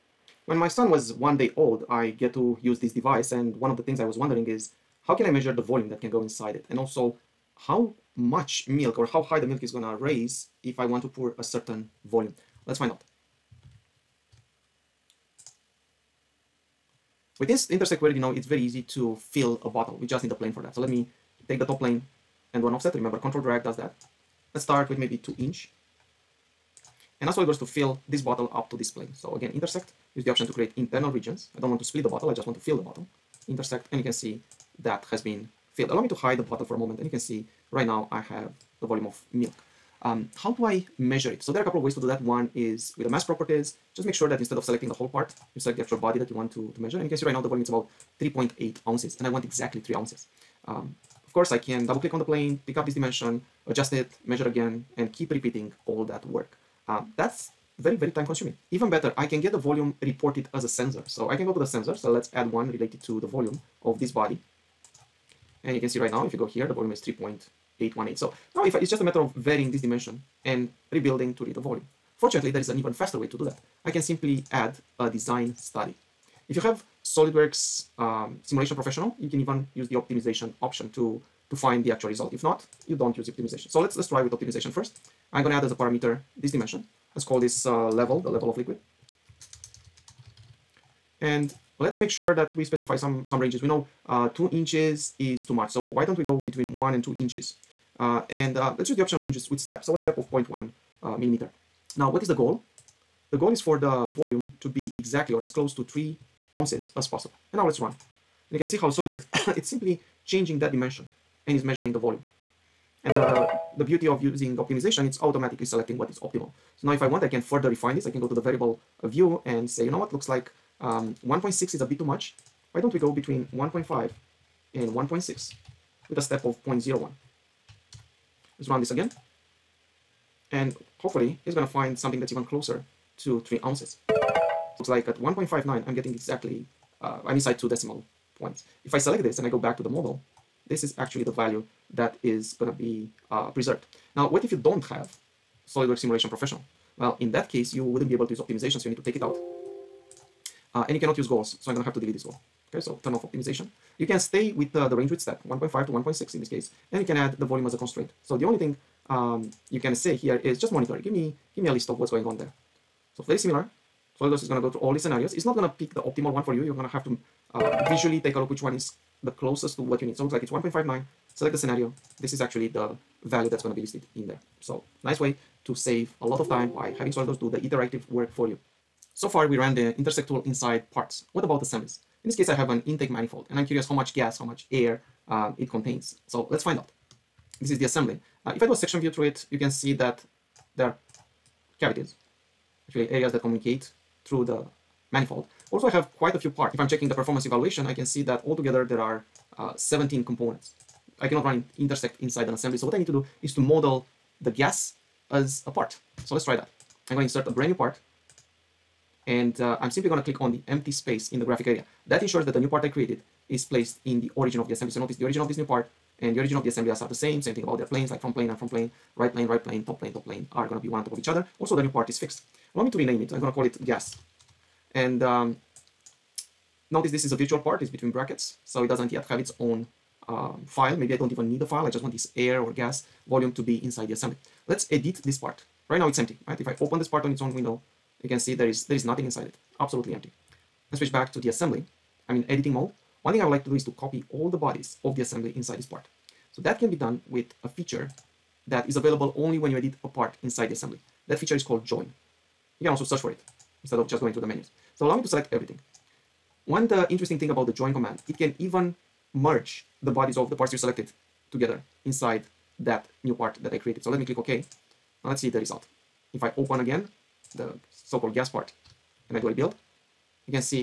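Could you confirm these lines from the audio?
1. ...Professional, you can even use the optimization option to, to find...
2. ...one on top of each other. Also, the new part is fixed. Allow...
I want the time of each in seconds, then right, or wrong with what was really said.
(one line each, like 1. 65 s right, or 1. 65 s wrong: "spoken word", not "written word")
1. 78 s right
2. 220 s right.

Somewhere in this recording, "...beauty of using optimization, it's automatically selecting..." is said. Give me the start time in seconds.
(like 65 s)
113 s.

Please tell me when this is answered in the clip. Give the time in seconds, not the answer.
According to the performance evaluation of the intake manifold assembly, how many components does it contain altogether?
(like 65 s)
199 s.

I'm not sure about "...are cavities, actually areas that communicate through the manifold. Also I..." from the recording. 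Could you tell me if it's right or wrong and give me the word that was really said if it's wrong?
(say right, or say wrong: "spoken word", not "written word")
right.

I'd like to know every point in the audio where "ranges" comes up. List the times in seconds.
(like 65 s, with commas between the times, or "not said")
93 s, 99 s, 154 s.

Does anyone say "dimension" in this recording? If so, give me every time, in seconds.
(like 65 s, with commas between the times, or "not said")
52 s, 69 s, 86 s, 110 s.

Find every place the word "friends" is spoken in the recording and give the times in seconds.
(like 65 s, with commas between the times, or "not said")
not said.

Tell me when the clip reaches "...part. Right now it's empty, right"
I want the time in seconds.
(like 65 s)
235 s.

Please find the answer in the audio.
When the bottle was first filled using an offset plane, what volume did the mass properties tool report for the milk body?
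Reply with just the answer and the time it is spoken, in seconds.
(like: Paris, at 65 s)
3.8 ounces, at 48 s.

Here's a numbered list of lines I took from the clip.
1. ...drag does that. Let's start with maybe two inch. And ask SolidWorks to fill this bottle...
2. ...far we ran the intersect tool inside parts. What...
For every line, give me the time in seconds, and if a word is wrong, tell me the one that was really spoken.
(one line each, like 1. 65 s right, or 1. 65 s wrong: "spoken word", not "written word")
1. 23 s right
2. 179 s right.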